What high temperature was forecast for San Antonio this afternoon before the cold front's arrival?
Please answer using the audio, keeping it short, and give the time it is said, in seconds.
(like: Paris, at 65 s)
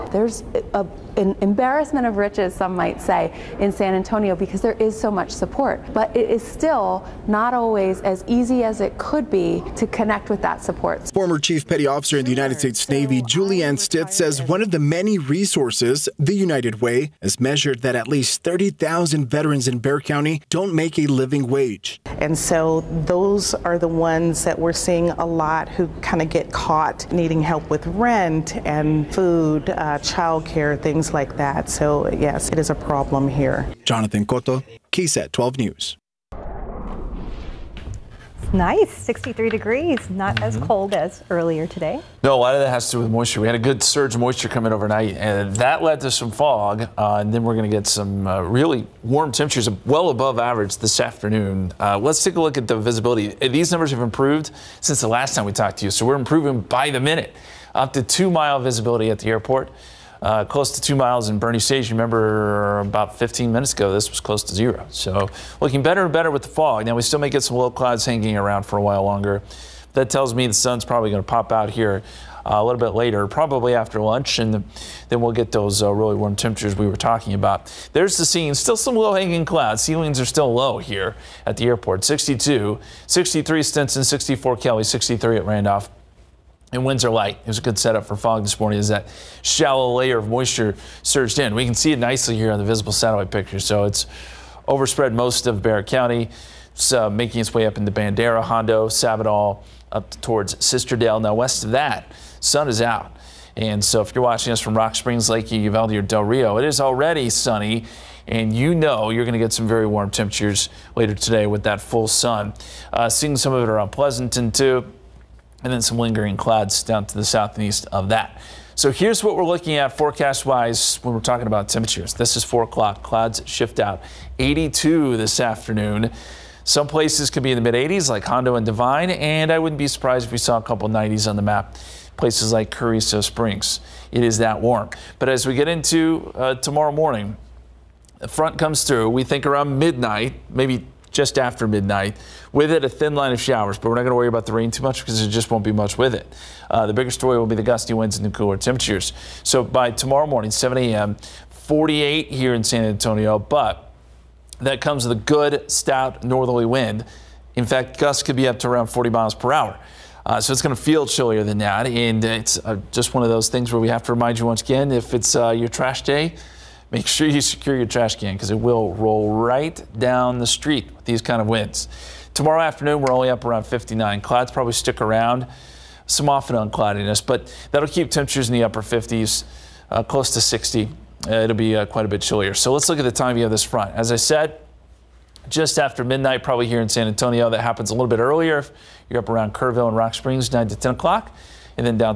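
82, at 124 s.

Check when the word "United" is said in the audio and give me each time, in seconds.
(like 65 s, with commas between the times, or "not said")
12 s, 16 s.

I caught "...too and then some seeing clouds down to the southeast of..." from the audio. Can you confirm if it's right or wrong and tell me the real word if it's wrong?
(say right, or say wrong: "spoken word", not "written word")
wrong: "lingering", not "seeing".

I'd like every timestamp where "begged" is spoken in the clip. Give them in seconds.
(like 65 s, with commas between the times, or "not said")
not said.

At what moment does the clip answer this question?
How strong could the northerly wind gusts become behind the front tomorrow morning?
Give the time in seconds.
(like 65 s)
158 s.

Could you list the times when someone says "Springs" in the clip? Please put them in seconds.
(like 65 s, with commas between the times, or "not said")
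104 s, 133 s, 190 s.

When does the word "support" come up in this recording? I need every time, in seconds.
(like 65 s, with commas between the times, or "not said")
5 s, 10 s.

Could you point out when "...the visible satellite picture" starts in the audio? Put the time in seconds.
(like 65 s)
92 s.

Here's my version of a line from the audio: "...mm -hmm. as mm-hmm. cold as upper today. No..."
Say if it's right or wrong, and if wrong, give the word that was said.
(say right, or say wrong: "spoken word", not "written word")
wrong: "earlier", not "upper".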